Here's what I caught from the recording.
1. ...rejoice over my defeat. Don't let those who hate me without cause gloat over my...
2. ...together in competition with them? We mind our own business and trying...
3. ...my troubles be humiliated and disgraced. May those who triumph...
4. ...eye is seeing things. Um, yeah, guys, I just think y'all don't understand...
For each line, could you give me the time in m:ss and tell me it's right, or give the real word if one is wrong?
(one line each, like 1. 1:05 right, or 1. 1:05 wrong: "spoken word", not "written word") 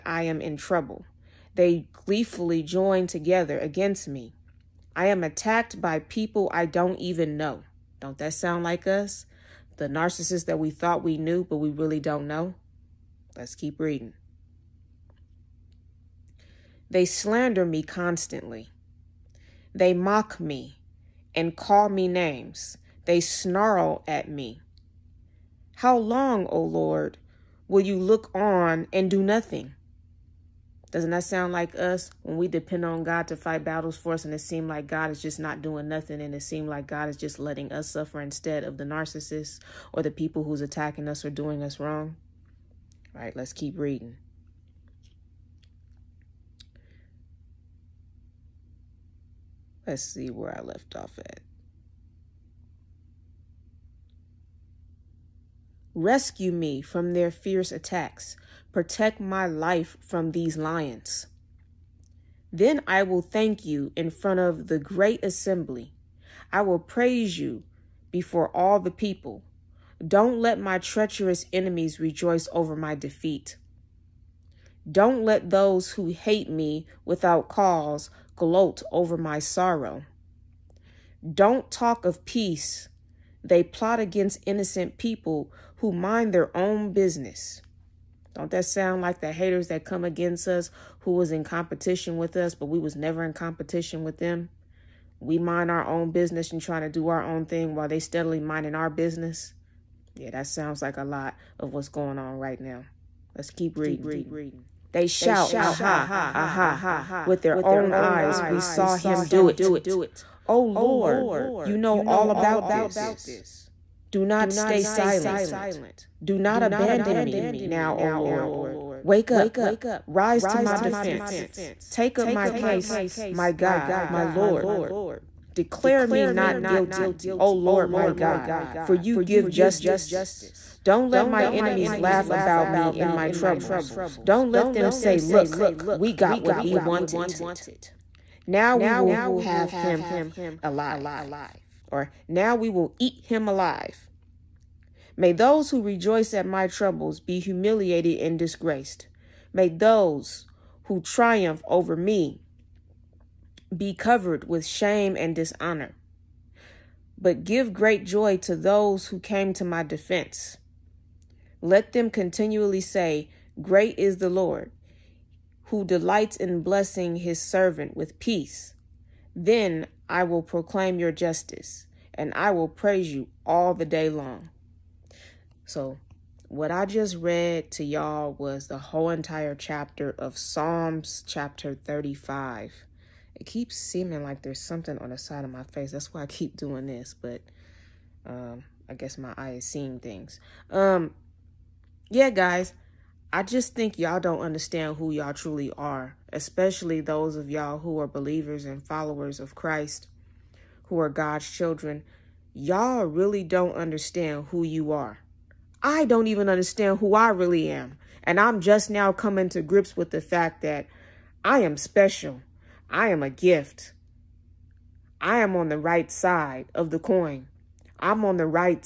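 1. 1:12 right
2. 1:32 wrong: "never", not "together"
3. 2:26 right
4. 3:09 right.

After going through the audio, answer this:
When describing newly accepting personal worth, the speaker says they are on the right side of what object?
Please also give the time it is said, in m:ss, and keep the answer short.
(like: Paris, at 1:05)
The coin, at 3:36.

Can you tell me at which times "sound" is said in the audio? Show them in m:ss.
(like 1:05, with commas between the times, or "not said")
0:08, 0:31, 1:28, 1:40.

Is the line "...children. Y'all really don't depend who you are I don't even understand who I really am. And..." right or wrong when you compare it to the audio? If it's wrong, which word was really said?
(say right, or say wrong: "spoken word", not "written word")
wrong: "understand", not "depend".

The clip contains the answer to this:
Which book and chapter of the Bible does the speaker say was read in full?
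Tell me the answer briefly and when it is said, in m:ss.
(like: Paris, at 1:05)
Psalms chapter 35, at 3:00.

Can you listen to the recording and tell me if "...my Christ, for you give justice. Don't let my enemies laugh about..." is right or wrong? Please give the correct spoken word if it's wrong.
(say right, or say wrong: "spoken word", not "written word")
wrong: "God", not "Christ".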